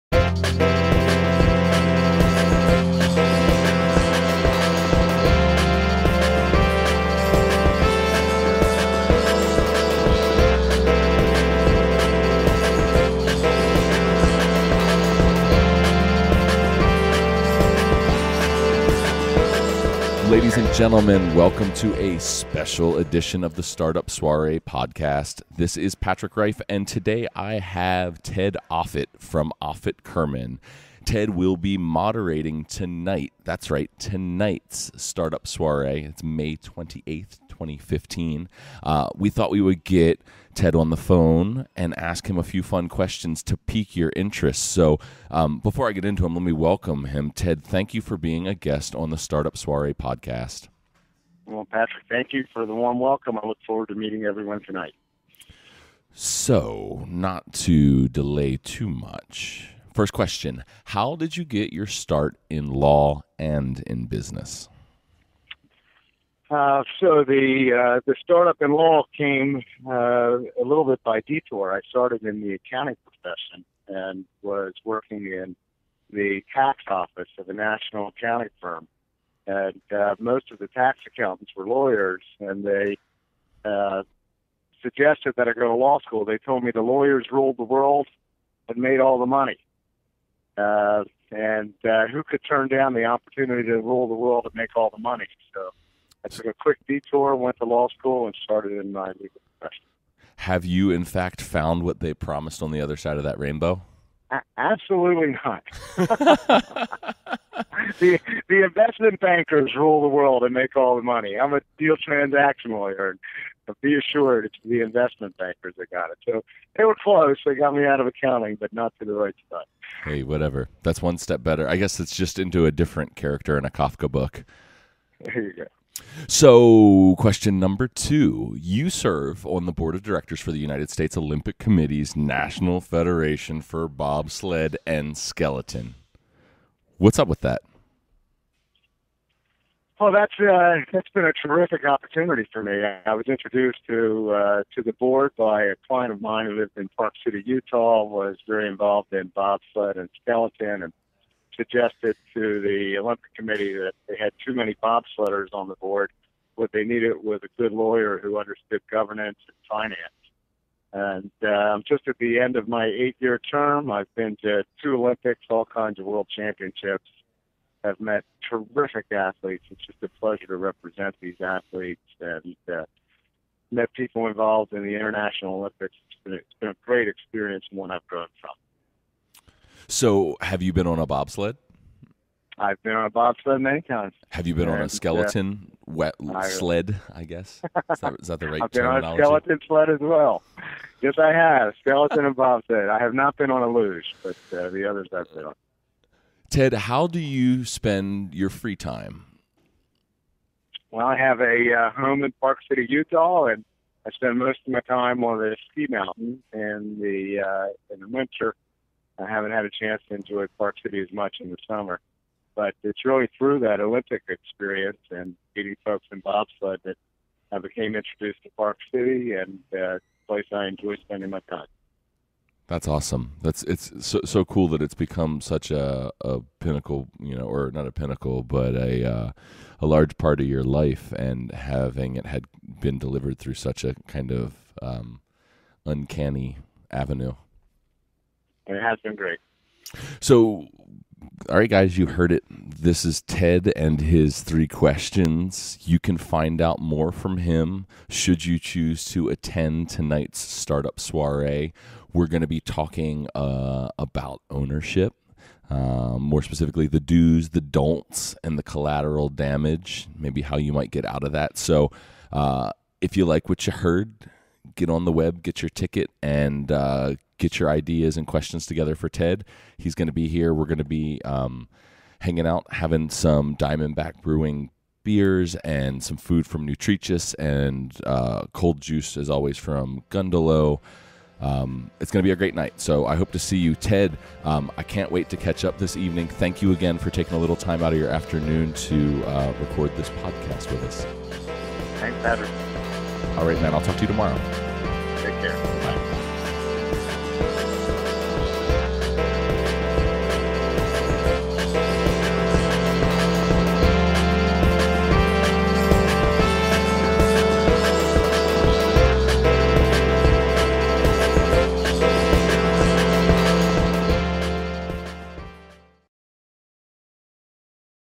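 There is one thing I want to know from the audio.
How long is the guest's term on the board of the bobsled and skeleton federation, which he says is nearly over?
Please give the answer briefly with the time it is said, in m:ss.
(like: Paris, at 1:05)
8 years, at 2:42.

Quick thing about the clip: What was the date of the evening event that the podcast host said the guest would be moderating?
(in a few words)
May 28th, 2015.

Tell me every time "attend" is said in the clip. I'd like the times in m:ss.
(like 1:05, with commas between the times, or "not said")
4:09.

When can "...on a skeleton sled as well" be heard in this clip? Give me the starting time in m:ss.
3:08.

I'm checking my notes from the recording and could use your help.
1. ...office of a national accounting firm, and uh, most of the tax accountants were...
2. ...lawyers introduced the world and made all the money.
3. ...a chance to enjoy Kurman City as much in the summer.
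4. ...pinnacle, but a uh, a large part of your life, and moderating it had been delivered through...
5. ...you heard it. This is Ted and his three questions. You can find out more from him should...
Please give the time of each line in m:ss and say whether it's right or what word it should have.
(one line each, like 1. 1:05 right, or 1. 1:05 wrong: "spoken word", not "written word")
1. 1:16 right
2. 1:26 wrong: "ruled", not "introduced"
3. 3:29 wrong: "Park", not "Kurman"
4. 3:47 wrong: "having", not "moderating"
5. 4:01 right.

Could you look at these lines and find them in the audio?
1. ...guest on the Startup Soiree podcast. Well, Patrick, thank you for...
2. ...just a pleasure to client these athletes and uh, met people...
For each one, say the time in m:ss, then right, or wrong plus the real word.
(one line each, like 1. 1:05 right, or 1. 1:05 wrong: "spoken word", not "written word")
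1. 0:48 right
2. 2:49 wrong: "represent", not "client".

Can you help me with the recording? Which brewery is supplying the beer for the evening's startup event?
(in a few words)
Diamondback Brewing.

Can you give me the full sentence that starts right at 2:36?
What they needed was a good lawyer who understood governance and finance.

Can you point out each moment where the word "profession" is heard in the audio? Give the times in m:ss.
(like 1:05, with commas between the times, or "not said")
1:13, 1:39.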